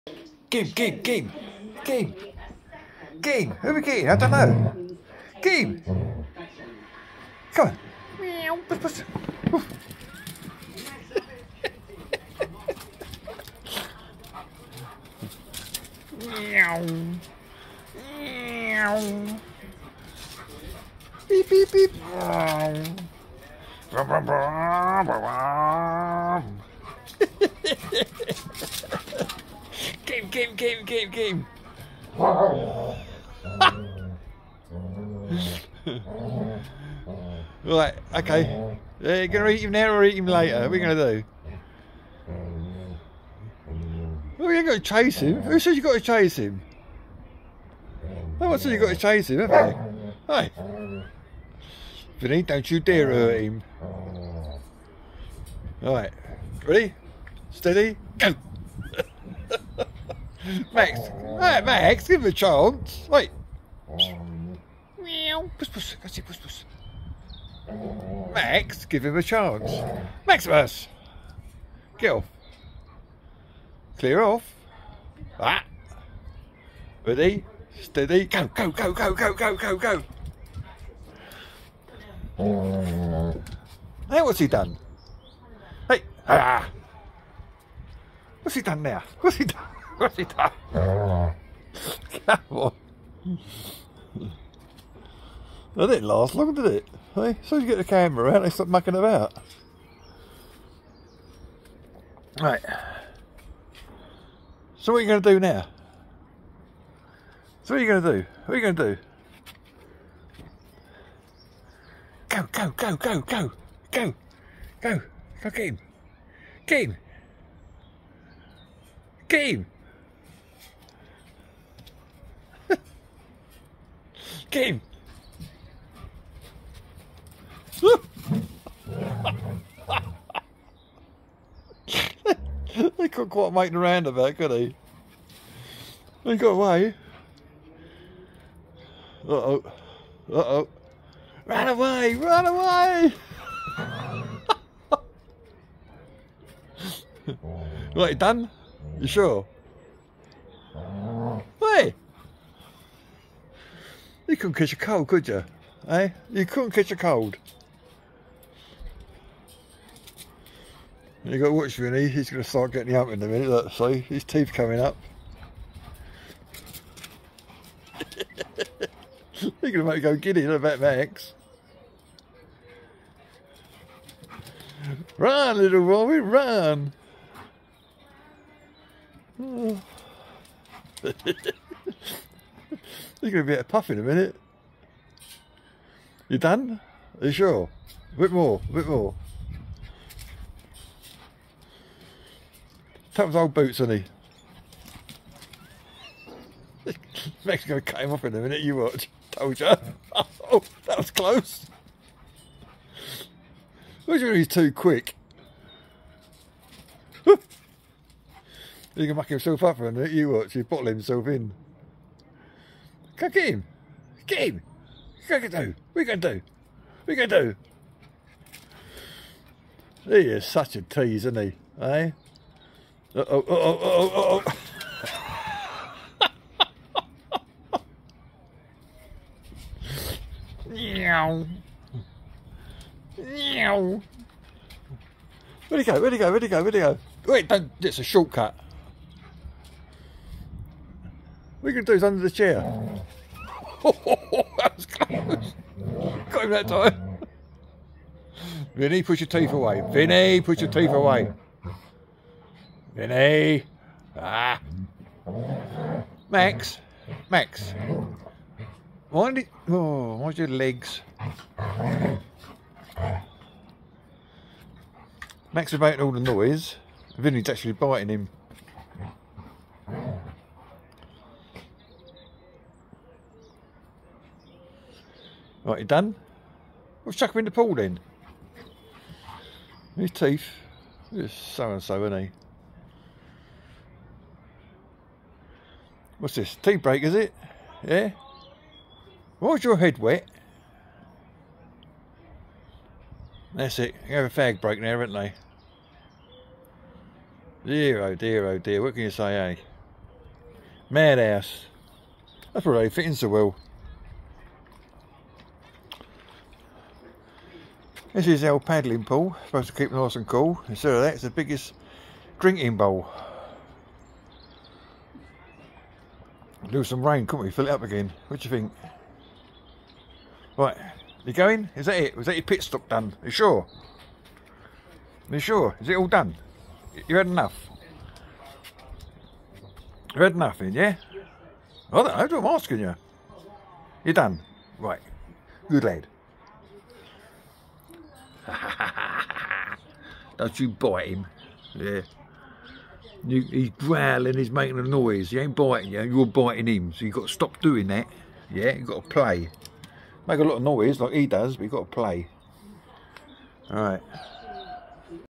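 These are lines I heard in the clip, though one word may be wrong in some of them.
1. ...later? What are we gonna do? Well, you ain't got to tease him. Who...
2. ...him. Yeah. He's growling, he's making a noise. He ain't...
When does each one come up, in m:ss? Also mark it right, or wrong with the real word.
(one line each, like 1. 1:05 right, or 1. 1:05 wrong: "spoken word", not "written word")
1. 0:40 wrong: "chase", not "tease"
2. 5:41 right.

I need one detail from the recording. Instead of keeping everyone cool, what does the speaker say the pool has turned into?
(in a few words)
Biggest drinking bowl.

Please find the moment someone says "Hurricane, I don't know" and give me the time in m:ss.
0:03.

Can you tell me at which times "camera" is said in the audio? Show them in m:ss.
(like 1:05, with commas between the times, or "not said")
1:37.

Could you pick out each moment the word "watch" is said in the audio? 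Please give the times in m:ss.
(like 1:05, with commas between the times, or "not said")
2:41, 3:18, 3:30.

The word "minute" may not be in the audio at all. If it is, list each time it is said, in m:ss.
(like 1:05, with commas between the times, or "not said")
2:43, 3:04, 3:18, 3:29.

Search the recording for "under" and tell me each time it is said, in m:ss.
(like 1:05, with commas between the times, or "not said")
4:02.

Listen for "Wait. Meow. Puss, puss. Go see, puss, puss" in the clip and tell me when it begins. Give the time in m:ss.
1:03.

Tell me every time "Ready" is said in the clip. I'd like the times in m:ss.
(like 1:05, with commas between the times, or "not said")
0:56, 1:17.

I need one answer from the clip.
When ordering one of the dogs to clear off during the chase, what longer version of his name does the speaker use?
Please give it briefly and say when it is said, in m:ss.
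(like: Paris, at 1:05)
Maximus, at 1:10.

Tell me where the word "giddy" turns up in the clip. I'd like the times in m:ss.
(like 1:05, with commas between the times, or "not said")
2:50.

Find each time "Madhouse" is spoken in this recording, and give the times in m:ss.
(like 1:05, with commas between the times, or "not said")
5:00.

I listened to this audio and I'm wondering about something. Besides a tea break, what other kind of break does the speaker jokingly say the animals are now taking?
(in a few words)
Fag break.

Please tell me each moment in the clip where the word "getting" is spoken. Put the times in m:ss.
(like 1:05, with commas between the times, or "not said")
2:42.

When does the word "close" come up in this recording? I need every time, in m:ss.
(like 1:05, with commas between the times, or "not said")
3:21, 4:04.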